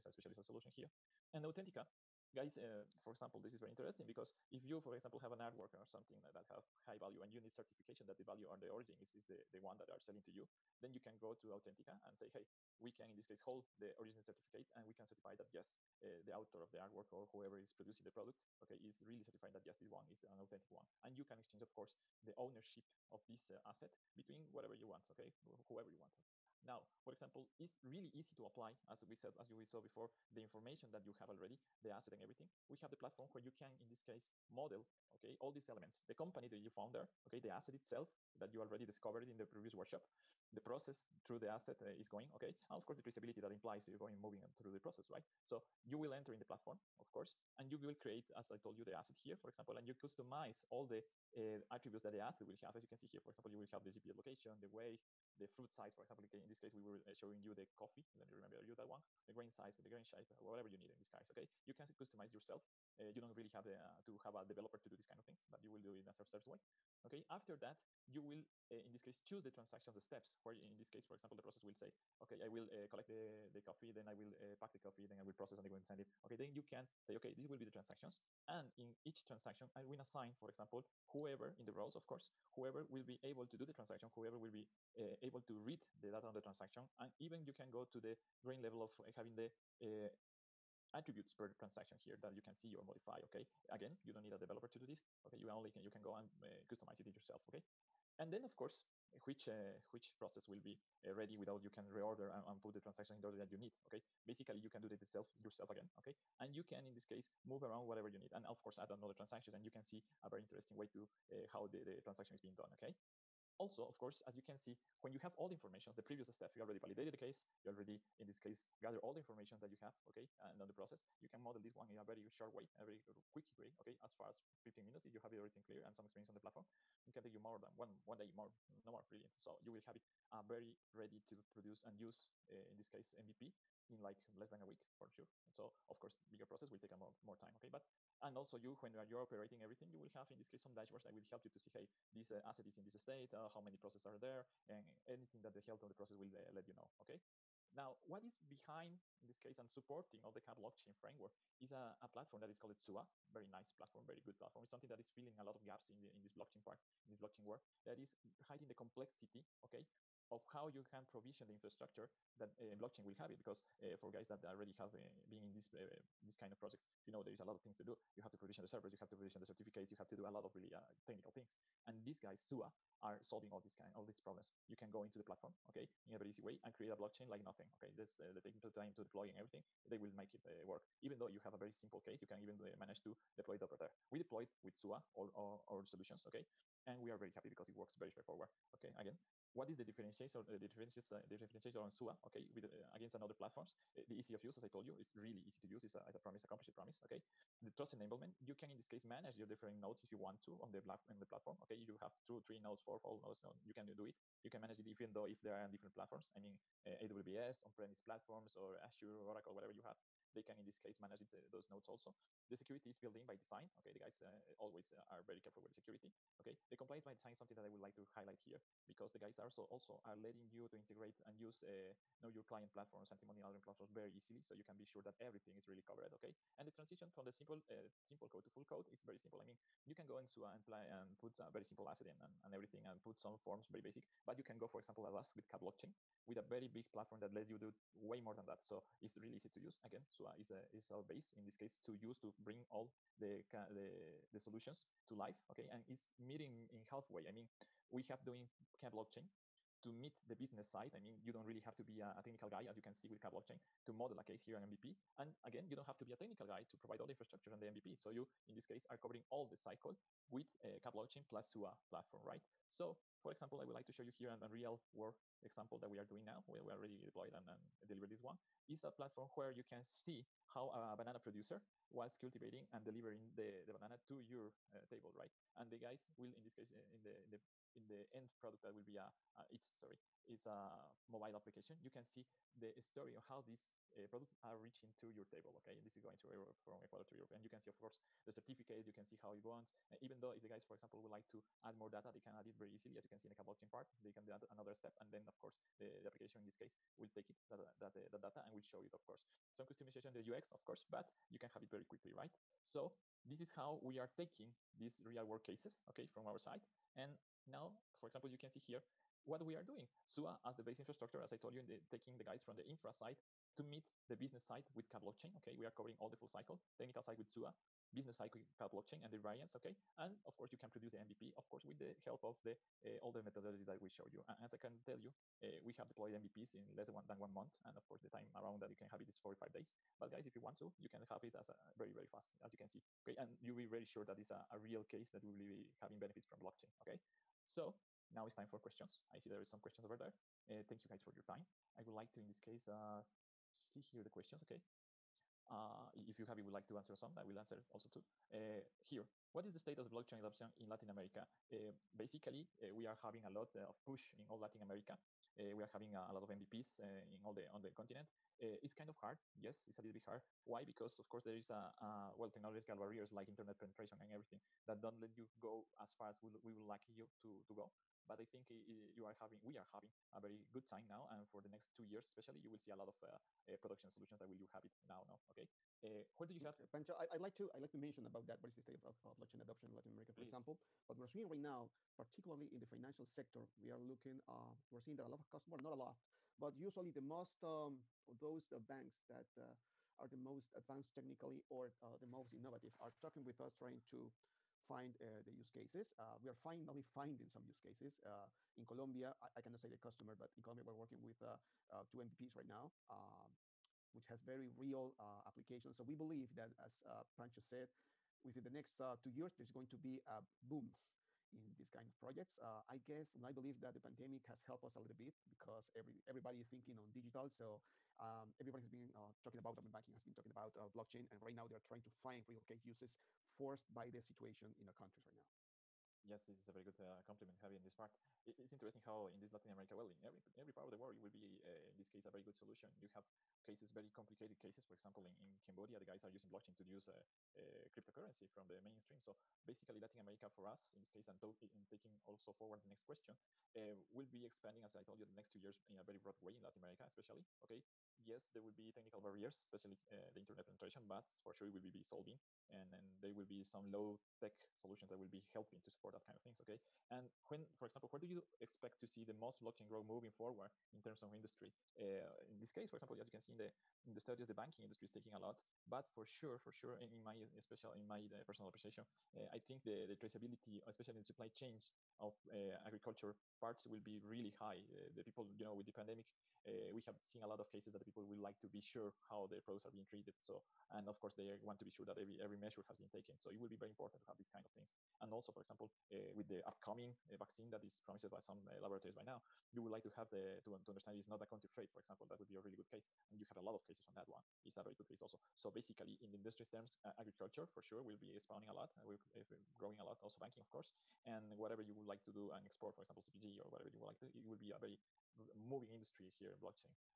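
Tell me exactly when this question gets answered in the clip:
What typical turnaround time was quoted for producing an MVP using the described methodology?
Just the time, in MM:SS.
05:29.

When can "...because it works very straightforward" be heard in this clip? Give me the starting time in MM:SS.
03:07.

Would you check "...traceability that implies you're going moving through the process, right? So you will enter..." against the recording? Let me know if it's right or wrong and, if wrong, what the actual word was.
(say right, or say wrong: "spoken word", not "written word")
right.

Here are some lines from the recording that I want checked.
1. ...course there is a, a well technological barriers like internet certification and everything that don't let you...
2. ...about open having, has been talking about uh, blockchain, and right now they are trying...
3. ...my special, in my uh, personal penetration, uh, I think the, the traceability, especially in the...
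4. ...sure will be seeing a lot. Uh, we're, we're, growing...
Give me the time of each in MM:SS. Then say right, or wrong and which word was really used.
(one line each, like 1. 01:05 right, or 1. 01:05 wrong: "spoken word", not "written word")
1. 06:01 wrong: "penetration", not "certification"
2. 06:59 wrong: "banking", not "having"
3. 07:47 wrong: "appreciation", not "penetration"
4. 08:17 wrong: "spawning", not "seeing".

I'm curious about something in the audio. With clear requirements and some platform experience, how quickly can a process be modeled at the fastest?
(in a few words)
15 minutes.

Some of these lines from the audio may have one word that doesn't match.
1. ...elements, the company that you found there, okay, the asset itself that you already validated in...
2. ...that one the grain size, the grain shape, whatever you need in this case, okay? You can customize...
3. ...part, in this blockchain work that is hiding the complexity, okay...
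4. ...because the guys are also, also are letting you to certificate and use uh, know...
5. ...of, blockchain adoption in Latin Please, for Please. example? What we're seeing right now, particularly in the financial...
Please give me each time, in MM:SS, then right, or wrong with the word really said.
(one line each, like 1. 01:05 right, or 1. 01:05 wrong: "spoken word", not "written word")
1. 00:35 wrong: "discovered", not "validated"
2. 00:58 right
3. 02:36 right
4. 03:38 wrong: "integrate", not "certificate"
5. 06:19 wrong: "America", not "Please".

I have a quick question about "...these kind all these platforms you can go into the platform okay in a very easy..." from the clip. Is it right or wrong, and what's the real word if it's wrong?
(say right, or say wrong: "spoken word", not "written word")
wrong: "problems", not "platforms".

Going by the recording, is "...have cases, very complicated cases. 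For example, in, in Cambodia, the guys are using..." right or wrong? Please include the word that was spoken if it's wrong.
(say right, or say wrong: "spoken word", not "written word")
right.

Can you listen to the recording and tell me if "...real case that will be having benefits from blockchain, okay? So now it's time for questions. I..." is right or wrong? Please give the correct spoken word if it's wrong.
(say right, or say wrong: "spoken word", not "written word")
right.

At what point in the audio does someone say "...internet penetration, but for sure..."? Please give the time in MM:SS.
07:30.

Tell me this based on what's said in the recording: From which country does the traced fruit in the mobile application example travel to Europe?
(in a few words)
Ecuador.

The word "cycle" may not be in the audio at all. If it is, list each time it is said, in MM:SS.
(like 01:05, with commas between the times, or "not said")
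04:19, 05:16.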